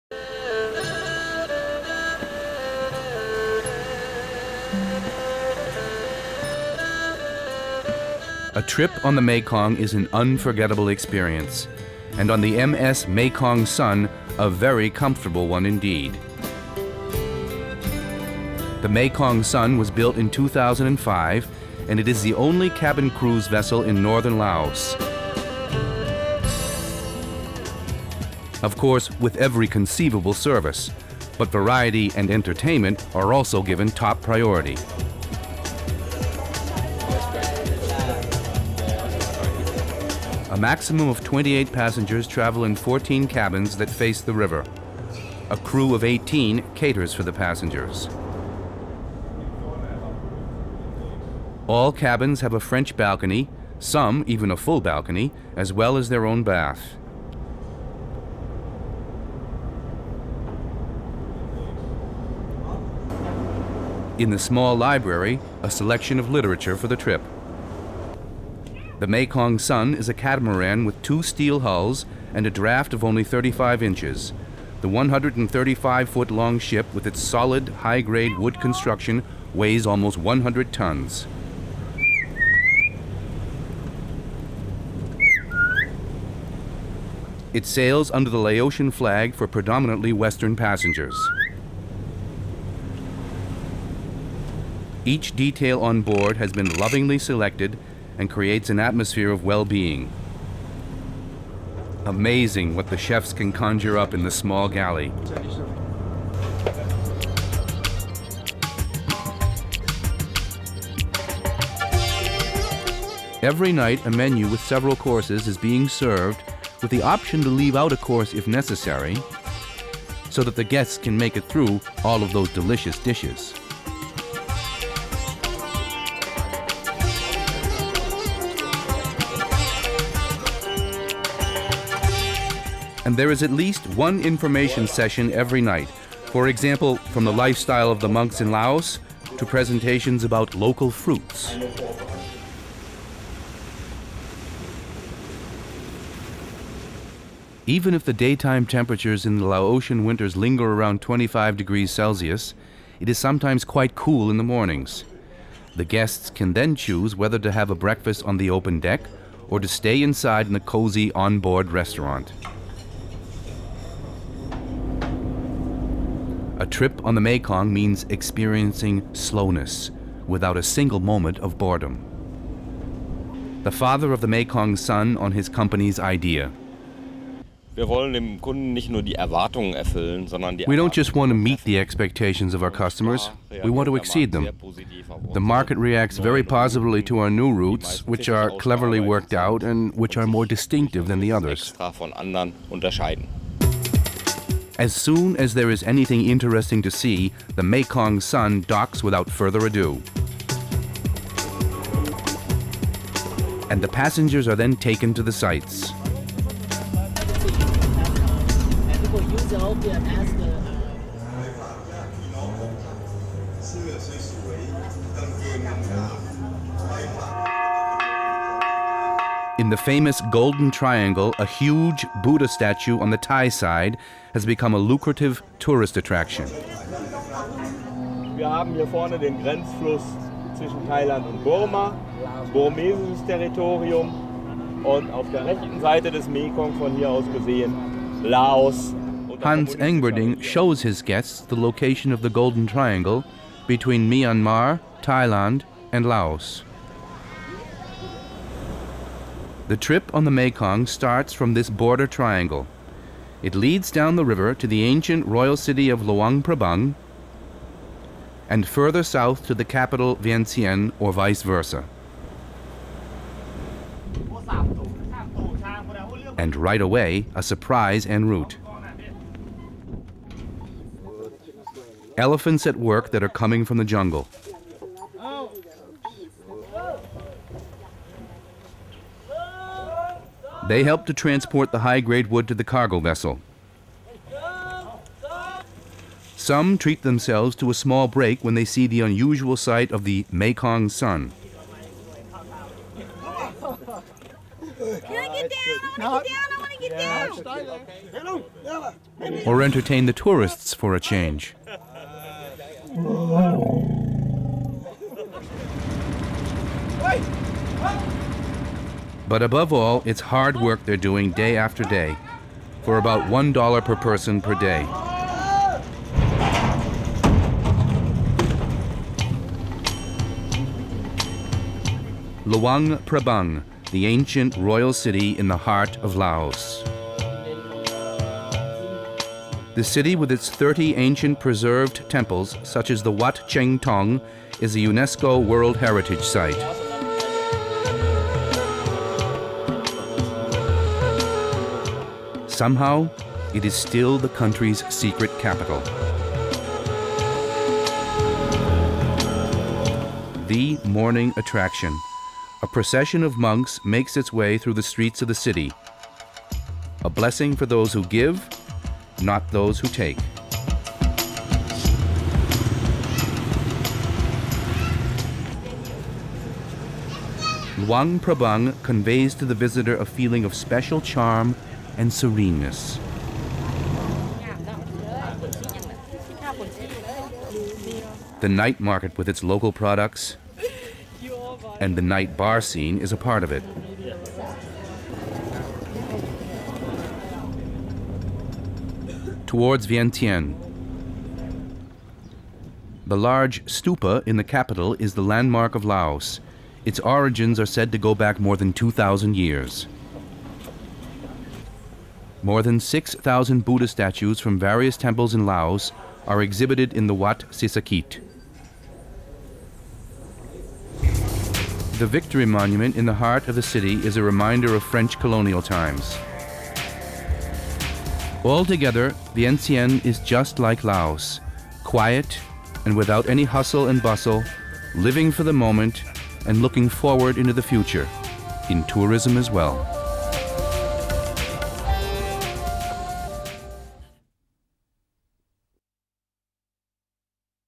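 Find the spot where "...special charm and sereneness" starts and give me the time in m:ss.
6:10.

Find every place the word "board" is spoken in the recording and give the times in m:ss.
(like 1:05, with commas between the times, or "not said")
1:36, 2:41.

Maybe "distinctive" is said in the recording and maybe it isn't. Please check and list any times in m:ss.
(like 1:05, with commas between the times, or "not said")
3:10.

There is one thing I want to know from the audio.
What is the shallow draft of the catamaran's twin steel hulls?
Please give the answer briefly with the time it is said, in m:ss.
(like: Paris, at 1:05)
35 inches, at 1:13.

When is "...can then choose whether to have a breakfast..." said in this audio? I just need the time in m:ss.
2:36.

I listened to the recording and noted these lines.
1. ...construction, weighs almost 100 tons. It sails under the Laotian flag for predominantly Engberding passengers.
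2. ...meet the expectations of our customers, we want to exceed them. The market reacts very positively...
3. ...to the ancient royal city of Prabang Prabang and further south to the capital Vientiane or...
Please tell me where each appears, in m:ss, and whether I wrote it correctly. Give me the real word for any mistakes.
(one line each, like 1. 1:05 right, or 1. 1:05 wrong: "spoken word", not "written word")
1. 1:18 wrong: "Western", not "Engberding"
2. 3:01 right
3. 4:14 wrong: "Luang", not "Prabang".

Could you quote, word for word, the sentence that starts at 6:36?
Its origins are said to go back more than 2,000 years.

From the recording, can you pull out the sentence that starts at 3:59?
Hans Engberding shows his guests the location of the Golden Triangle between Myanmar, Thailand and Laos.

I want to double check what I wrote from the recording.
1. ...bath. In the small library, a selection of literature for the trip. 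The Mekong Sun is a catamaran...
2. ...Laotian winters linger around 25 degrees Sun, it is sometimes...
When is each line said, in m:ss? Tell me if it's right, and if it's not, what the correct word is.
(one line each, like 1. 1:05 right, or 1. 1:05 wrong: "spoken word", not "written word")
1. 0:56 right
2. 2:29 wrong: "Celsius", not "Sun".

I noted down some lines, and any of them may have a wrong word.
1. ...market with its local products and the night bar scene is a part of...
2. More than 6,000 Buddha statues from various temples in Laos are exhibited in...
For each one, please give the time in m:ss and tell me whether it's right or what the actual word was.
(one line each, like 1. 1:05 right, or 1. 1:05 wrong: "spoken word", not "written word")
1. 6:18 right
2. 6:42 right.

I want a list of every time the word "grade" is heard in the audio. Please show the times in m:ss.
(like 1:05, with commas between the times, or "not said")
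1:18, 4:41.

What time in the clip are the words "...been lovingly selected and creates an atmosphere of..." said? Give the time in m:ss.
1:36.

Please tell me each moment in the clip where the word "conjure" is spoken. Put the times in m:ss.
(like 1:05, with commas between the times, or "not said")
1:43.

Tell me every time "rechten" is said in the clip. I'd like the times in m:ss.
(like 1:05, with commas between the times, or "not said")
3:55.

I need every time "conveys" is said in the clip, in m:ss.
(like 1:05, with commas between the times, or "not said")
6:08.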